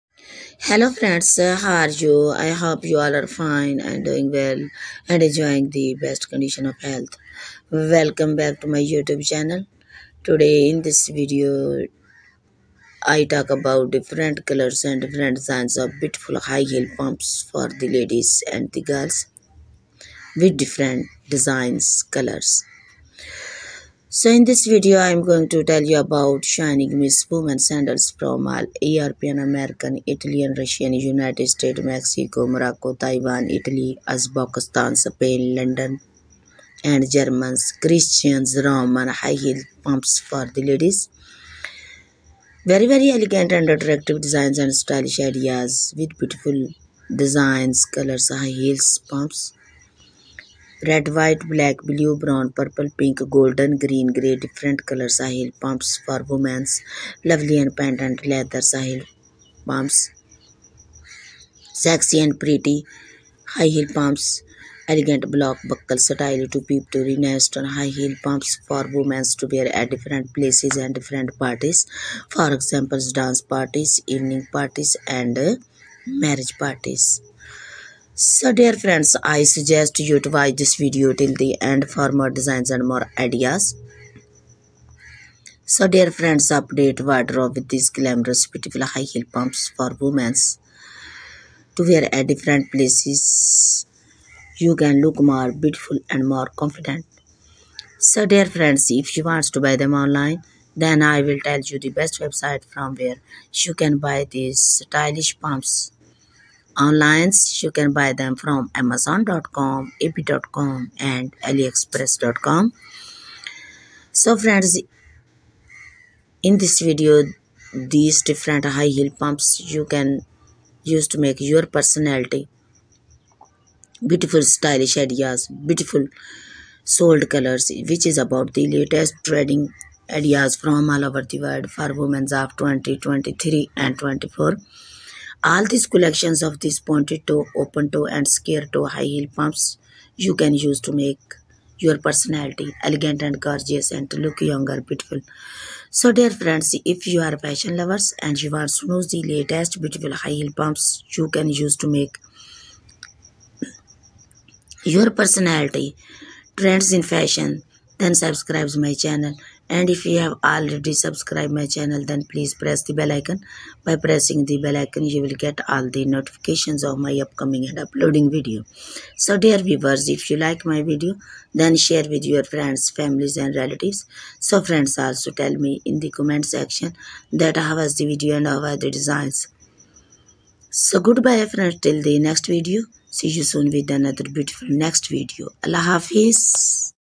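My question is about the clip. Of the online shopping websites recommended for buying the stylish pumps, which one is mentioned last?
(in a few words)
aliexpress.com.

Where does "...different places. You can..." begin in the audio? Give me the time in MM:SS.
01:32.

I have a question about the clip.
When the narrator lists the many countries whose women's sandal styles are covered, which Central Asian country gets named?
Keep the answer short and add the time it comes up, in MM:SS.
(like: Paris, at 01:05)
Uzbekistan, at 00:34.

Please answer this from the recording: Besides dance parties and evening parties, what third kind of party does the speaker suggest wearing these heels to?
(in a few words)
Marriage parties.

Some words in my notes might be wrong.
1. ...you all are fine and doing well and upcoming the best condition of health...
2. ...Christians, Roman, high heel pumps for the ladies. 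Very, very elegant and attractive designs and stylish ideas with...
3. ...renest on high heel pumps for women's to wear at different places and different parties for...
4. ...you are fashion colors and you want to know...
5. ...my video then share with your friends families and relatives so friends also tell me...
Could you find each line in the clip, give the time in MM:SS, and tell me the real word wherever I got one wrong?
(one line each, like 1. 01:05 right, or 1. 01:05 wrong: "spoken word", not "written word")
1. 00:02 wrong: "enjoying", not "upcoming"
2. 00:37 right
3. 01:07 right
4. 02:27 wrong: "lovers", not "colors"
5. 02:50 right.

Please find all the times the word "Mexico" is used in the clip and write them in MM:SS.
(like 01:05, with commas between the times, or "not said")
00:31.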